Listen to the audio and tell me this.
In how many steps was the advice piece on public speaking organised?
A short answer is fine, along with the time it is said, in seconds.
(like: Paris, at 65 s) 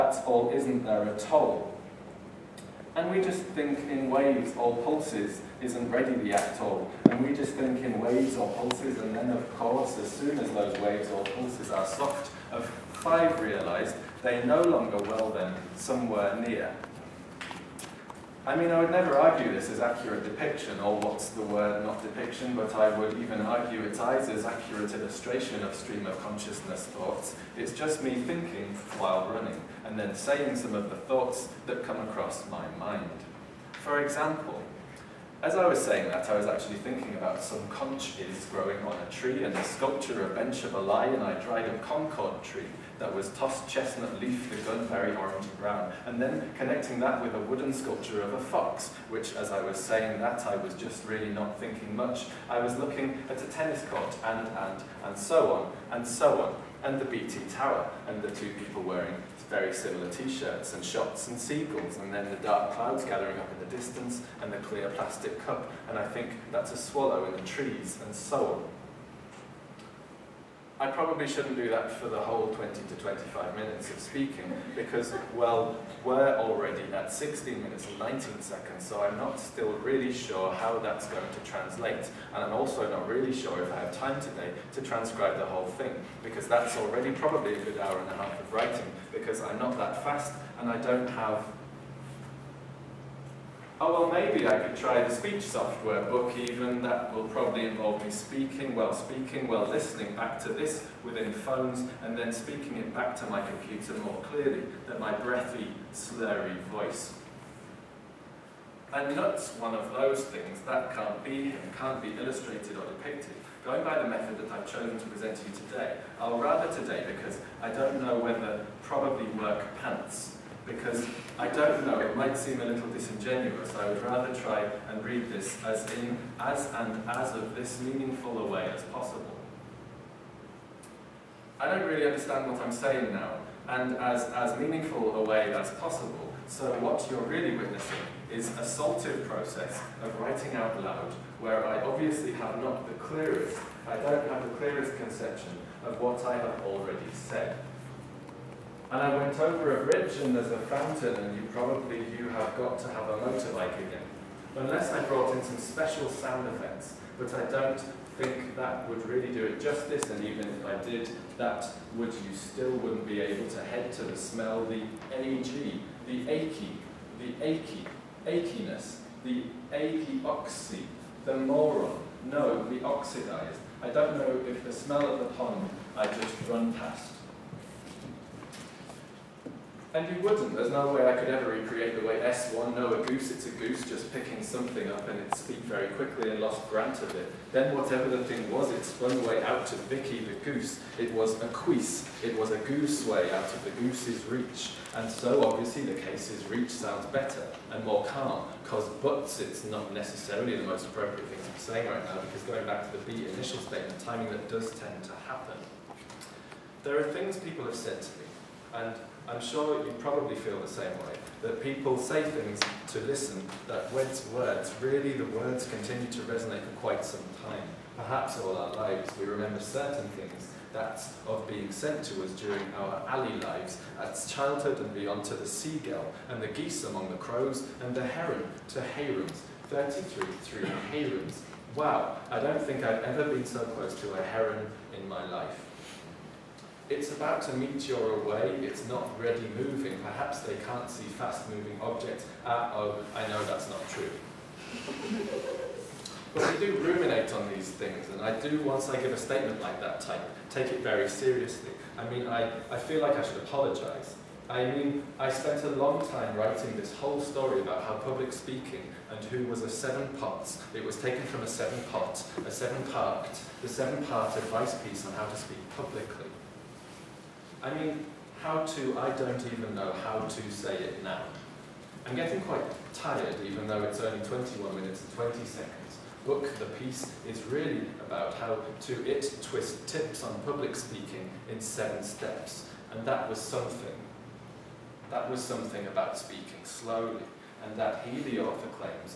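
7, at 281 s.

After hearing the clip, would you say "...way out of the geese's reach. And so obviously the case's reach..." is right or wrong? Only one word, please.
wrong.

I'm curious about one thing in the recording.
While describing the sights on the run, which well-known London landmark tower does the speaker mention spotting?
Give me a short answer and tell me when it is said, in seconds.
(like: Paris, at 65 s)
BT Tower, at 57 s.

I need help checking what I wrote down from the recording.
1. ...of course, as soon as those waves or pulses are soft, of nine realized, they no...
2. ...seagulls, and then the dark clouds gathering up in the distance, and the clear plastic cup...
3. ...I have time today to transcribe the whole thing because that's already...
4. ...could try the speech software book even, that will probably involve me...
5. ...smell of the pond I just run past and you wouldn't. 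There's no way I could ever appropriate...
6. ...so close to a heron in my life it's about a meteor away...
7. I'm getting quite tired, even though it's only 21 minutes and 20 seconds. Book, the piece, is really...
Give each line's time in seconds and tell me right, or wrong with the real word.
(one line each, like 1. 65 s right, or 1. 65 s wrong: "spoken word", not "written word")
1. 9 s wrong: "five", not "nine"
2. 61 s right
3. 83 s right
4. 94 s right
5. 174 s wrong: "recreate", not "appropriate"
6. 233 s right
7. 272 s right.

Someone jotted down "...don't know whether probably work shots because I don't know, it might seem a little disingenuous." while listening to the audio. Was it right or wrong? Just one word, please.
wrong.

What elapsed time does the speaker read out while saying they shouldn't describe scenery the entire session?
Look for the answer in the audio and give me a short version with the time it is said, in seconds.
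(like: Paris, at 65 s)
16 minutes and 19 seconds, at 77 s.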